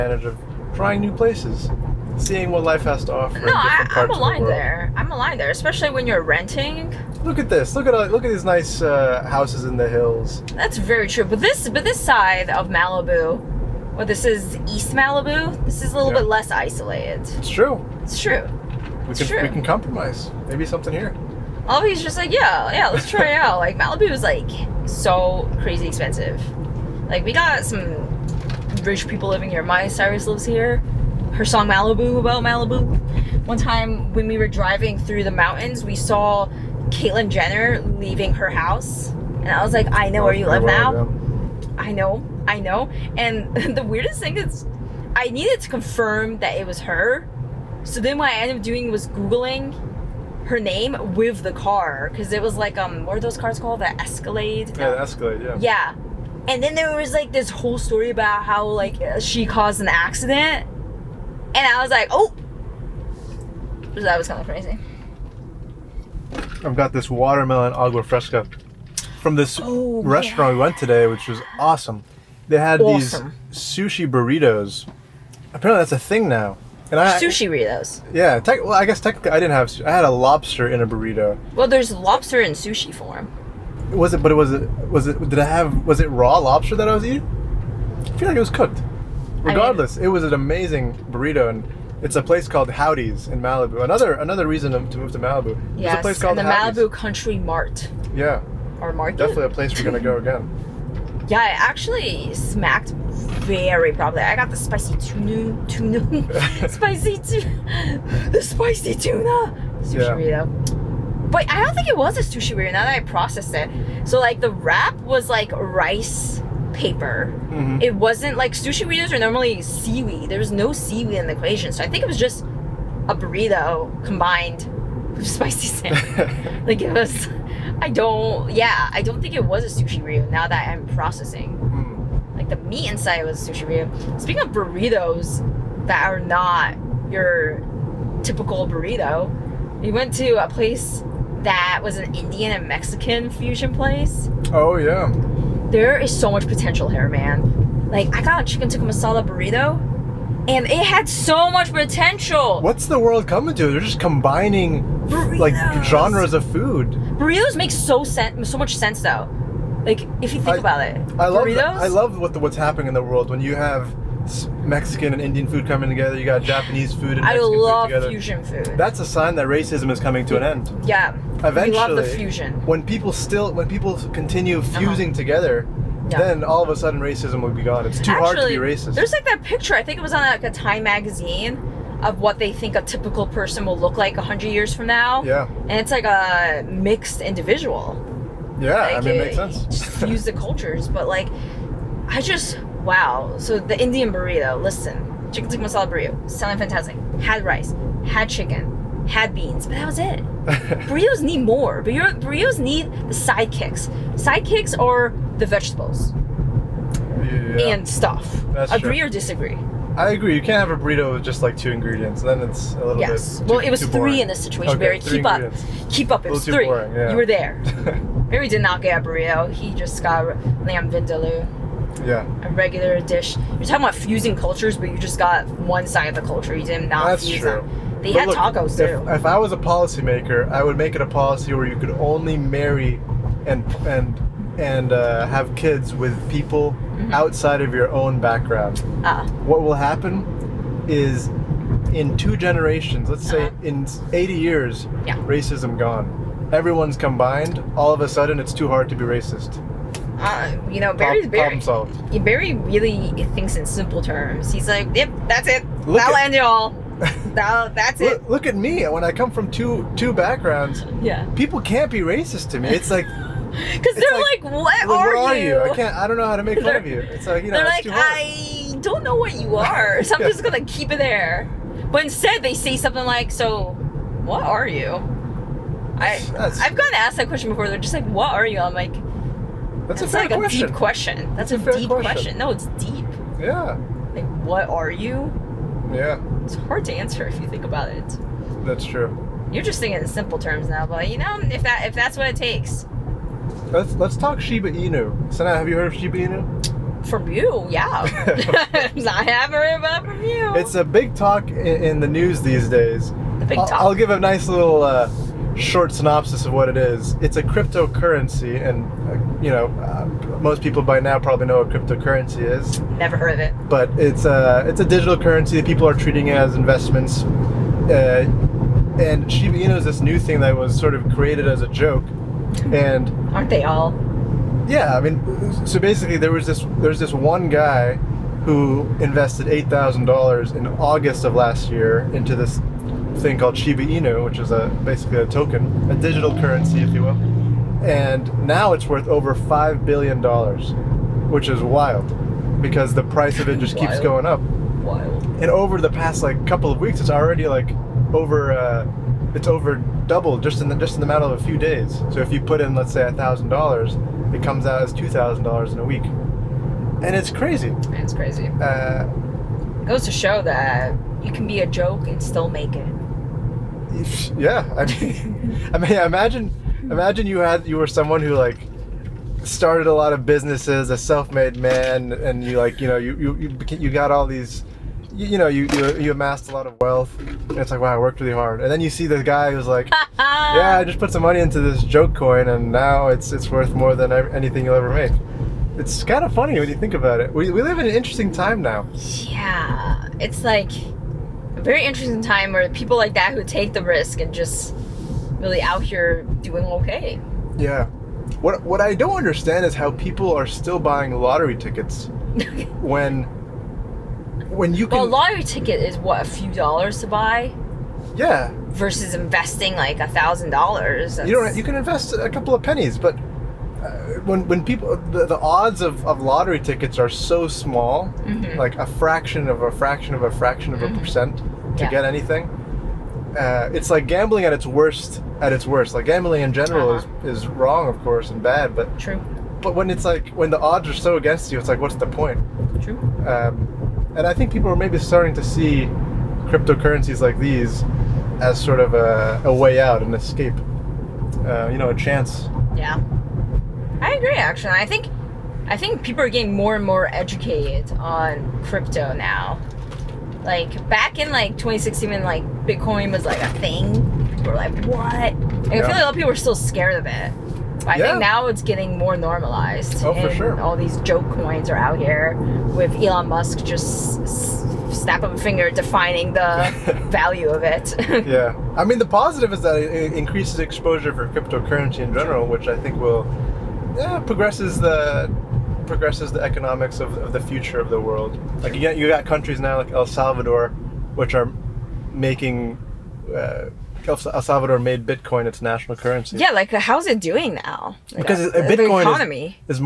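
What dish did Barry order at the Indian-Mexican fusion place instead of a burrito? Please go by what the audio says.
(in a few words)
Lamb vindaloo.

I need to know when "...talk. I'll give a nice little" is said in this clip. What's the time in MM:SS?
05:03.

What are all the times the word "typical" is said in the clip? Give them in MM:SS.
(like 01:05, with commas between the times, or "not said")
02:18, 03:02.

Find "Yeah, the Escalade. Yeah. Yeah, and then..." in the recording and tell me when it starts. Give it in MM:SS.
00:54.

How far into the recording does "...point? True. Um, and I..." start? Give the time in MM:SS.
07:12.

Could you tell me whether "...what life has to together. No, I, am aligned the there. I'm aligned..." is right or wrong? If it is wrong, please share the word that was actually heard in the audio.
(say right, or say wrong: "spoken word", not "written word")
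wrong: "offer", not "together".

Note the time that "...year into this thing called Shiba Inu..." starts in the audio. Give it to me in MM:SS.
05:31.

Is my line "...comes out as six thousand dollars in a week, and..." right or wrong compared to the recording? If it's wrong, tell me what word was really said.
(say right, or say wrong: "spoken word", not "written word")
wrong: "two", not "six".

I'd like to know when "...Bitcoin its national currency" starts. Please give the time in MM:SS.
08:05.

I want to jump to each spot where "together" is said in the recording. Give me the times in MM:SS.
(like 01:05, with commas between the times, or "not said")
02:45, 02:55.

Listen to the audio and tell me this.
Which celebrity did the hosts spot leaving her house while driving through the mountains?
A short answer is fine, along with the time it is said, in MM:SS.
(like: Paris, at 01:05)
Caitlyn Jenner, at 00:36.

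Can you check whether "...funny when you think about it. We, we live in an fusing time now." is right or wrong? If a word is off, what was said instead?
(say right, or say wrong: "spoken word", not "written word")
wrong: "interesting", not "fusing".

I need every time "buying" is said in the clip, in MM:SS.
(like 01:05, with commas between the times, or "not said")
06:40.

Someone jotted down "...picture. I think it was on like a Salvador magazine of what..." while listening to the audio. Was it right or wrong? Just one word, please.
wrong.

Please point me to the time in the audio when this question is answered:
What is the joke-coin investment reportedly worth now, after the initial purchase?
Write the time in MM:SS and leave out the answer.
05:39.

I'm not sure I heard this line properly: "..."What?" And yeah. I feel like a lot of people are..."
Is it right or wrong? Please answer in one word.
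right.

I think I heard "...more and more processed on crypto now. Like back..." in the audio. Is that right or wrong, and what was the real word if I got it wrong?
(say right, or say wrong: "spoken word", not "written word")
wrong: "educated", not "processed".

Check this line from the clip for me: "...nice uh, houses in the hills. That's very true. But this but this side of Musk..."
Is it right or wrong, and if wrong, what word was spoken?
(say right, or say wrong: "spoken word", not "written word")
wrong: "Malibu", not "Musk".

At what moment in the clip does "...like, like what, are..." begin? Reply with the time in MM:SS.
04:24.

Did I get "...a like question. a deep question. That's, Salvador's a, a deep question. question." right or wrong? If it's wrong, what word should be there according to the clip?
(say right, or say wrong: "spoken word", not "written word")
wrong: "That", not "Salvador".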